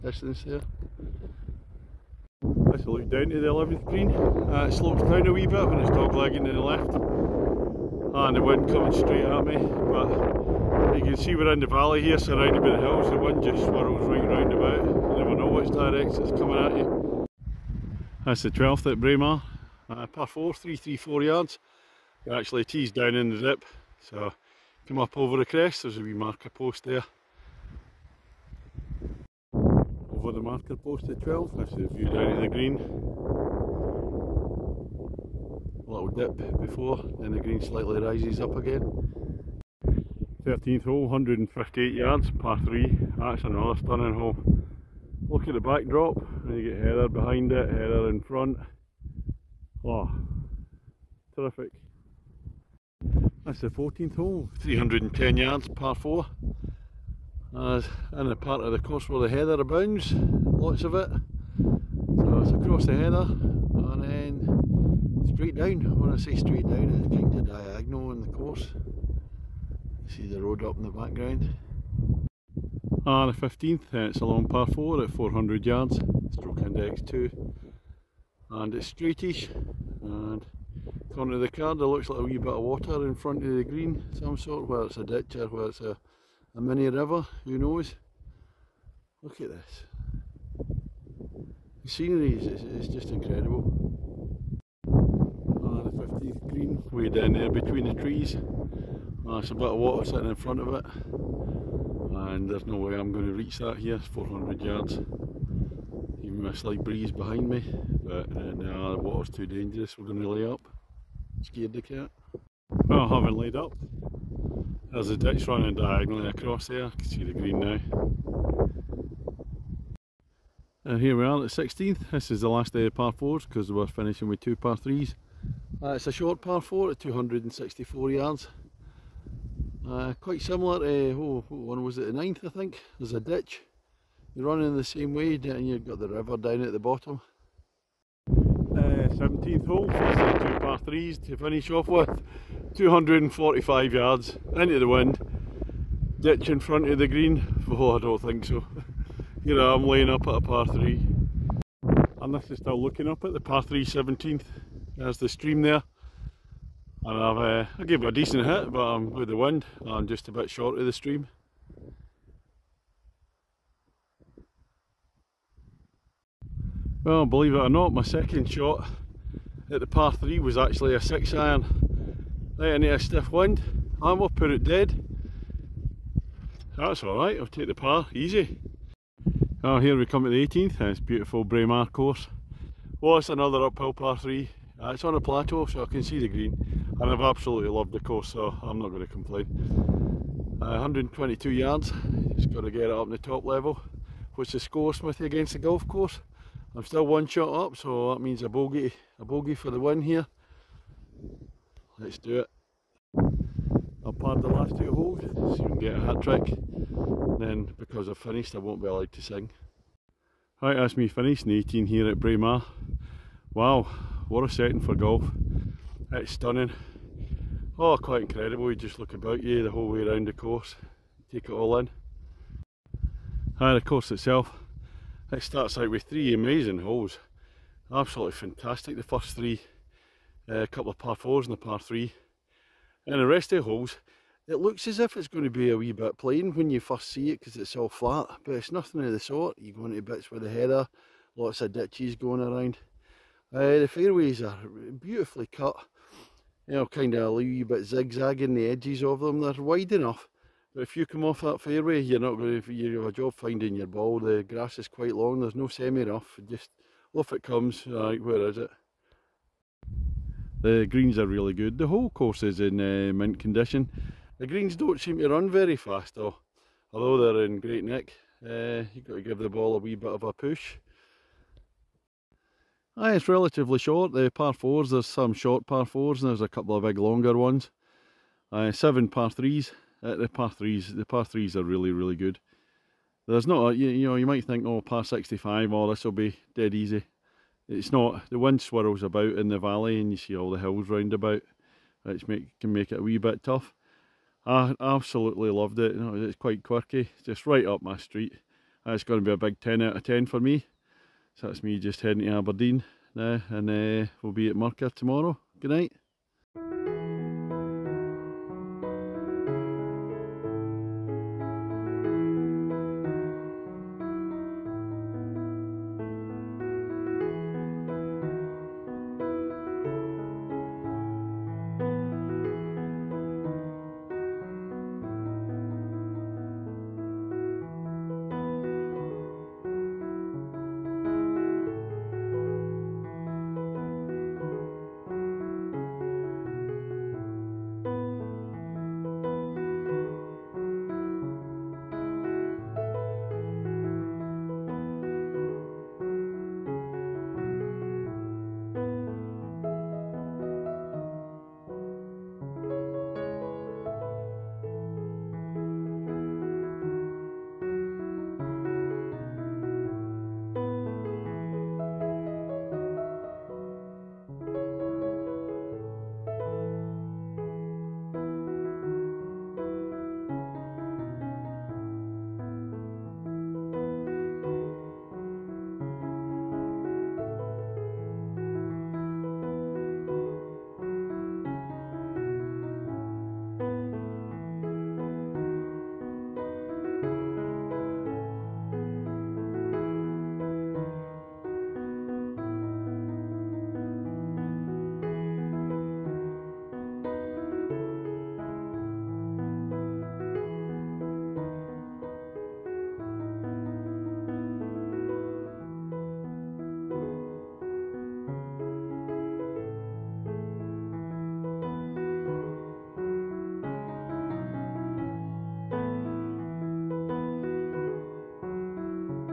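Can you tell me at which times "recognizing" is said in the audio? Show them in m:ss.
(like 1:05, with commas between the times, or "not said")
not said.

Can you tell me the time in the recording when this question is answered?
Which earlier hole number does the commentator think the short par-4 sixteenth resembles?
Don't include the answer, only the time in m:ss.
2:12.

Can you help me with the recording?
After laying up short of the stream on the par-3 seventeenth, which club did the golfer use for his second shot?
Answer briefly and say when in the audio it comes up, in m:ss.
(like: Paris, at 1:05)
6 iron, at 2:51.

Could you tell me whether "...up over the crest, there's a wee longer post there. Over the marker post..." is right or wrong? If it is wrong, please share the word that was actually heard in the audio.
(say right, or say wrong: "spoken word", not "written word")
wrong: "marker", not "longer".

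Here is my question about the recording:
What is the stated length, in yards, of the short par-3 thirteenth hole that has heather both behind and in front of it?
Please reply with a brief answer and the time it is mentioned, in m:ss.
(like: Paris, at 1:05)
158 yards, at 0:41.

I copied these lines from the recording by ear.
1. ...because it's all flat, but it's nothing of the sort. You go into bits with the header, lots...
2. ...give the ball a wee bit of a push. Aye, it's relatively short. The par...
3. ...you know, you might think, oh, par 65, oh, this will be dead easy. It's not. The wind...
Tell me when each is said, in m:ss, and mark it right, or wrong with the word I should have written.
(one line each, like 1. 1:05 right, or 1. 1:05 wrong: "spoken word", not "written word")
1. 3:57 right
2. 4:29 right
3. 4:43 right.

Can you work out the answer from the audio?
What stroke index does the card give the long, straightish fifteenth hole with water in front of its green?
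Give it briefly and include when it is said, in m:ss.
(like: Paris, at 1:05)
2, at 1:16.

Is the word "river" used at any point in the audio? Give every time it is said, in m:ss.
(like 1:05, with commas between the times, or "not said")
1:26, 2:16.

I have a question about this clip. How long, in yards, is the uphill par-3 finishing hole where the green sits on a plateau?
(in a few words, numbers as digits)
122 yards.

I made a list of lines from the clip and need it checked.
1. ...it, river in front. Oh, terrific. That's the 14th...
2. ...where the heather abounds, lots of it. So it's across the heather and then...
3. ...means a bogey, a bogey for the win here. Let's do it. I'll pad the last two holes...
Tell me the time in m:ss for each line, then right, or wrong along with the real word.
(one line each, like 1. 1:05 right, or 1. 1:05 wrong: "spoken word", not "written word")
1. 0:47 wrong: "heather", not "river"
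2. 0:59 right
3. 3:18 right.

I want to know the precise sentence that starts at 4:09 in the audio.
They're wide enough, but if you come off that fairway, you're not going to you have a job finding your ball.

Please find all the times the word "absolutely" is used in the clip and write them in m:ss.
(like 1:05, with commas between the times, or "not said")
3:07, 3:47, 4:54.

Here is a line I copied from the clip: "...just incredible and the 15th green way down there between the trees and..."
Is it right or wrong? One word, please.
right.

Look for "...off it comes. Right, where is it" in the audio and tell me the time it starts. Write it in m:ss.
4:17.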